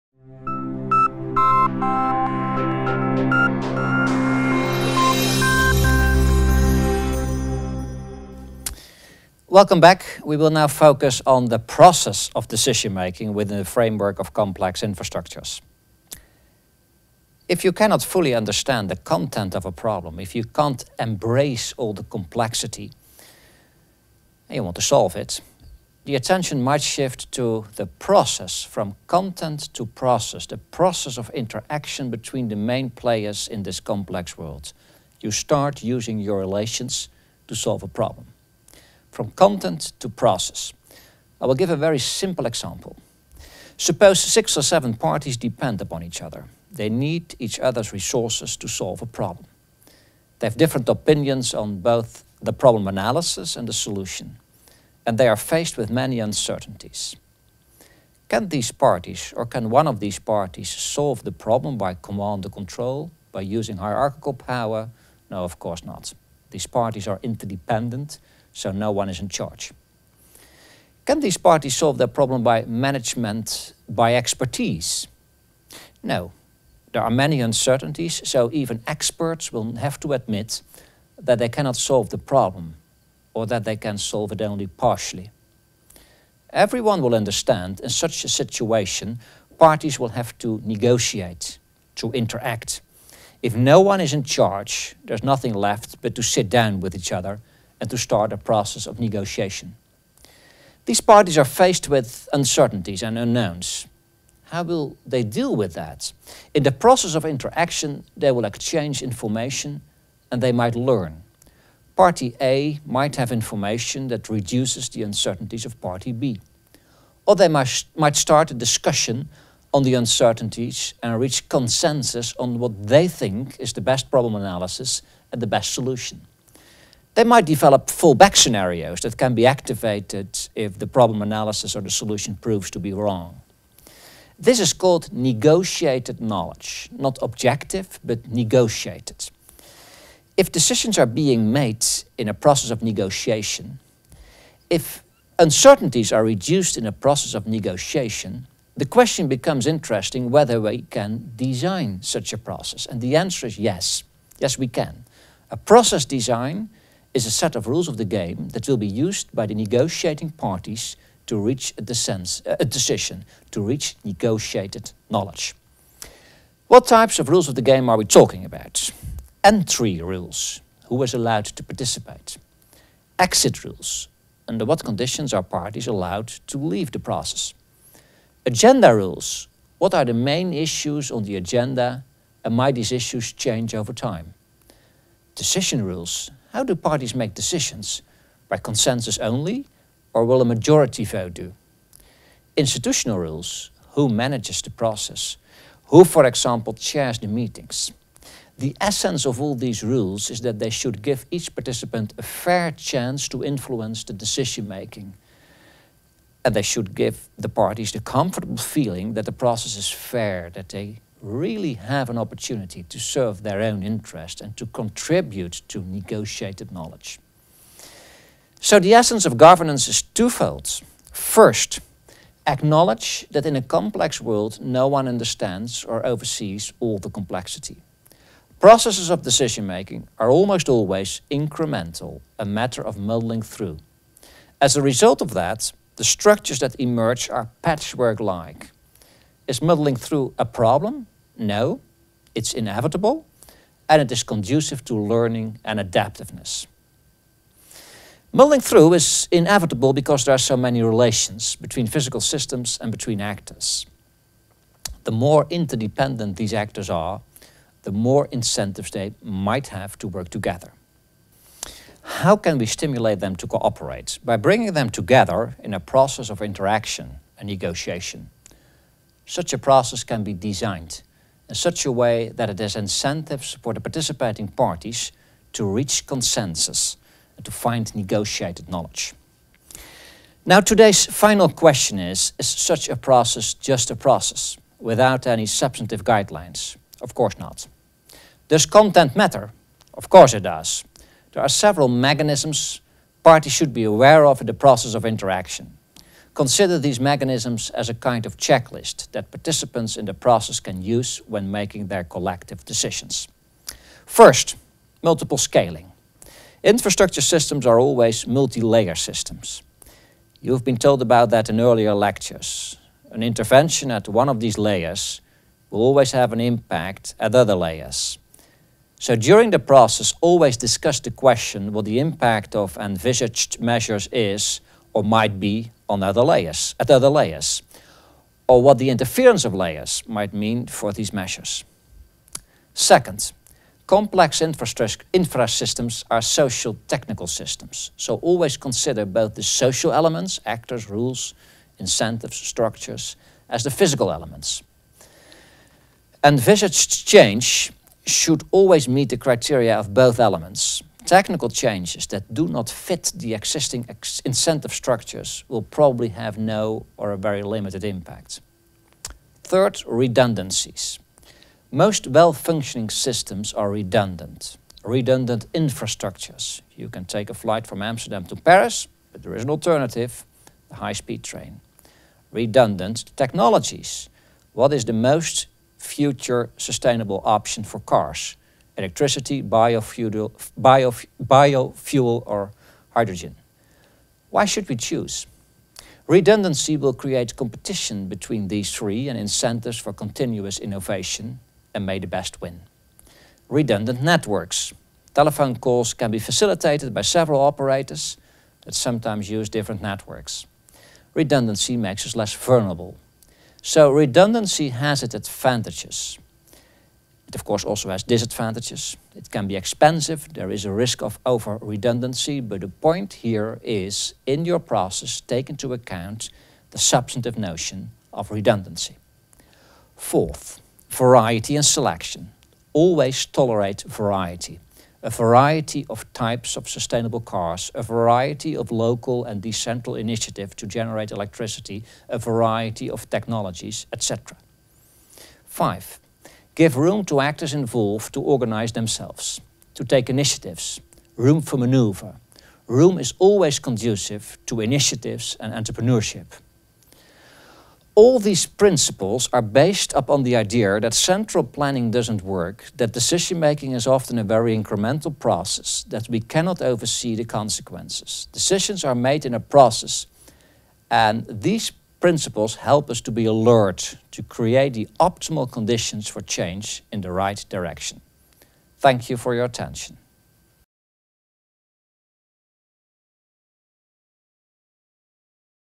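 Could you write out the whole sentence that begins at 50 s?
They have different opinions on both the problem analysis and the solution, and they are faced with many uncertainties.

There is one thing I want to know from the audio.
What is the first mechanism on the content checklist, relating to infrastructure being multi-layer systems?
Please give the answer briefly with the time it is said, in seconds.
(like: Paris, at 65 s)
multiple scaling, at 305 s.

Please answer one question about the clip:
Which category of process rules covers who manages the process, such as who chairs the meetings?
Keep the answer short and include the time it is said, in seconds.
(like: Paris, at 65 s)
Institutional rules, at 192 s.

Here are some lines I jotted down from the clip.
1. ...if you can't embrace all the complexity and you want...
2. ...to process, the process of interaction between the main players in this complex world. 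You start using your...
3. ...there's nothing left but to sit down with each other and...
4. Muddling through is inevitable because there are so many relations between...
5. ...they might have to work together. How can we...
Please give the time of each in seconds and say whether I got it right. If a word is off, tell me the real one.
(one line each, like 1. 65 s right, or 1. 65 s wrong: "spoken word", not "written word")
1. 20 s right
2. 29 s right
3. 95 s right
4. 248 s right
5. 258 s right.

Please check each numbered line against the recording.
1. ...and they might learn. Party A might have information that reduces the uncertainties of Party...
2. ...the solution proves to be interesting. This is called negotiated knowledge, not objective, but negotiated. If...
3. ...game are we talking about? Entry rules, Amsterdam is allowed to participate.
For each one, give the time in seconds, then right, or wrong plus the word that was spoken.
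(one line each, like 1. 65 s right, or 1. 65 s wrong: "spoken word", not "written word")
1. 110 s right
2. 131 s wrong: "wrong", not "interesting"
3. 167 s wrong: "Who", not "Amsterdam".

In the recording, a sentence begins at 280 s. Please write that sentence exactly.
Now today's final question is, is such a process just a process without any substantive guidelines?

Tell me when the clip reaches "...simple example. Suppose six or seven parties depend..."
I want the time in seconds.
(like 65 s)
41 s.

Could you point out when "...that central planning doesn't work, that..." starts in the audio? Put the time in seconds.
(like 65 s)
450 s.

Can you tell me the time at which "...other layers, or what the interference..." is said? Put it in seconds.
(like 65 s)
326 s.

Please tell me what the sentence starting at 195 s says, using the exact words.
Who, for example, chairs the meetings?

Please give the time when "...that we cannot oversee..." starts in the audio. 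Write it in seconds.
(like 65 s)
455 s.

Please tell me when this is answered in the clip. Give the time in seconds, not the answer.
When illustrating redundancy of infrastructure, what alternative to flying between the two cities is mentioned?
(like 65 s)
370 s.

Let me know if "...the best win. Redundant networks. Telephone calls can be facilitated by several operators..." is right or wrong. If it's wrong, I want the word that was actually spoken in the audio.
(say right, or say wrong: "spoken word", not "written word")
right.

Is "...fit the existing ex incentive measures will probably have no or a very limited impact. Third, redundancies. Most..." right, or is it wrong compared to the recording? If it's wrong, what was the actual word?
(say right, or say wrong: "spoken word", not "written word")
wrong: "structures", not "measures".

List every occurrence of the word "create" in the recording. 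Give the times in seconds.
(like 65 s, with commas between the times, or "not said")
386 s, 464 s.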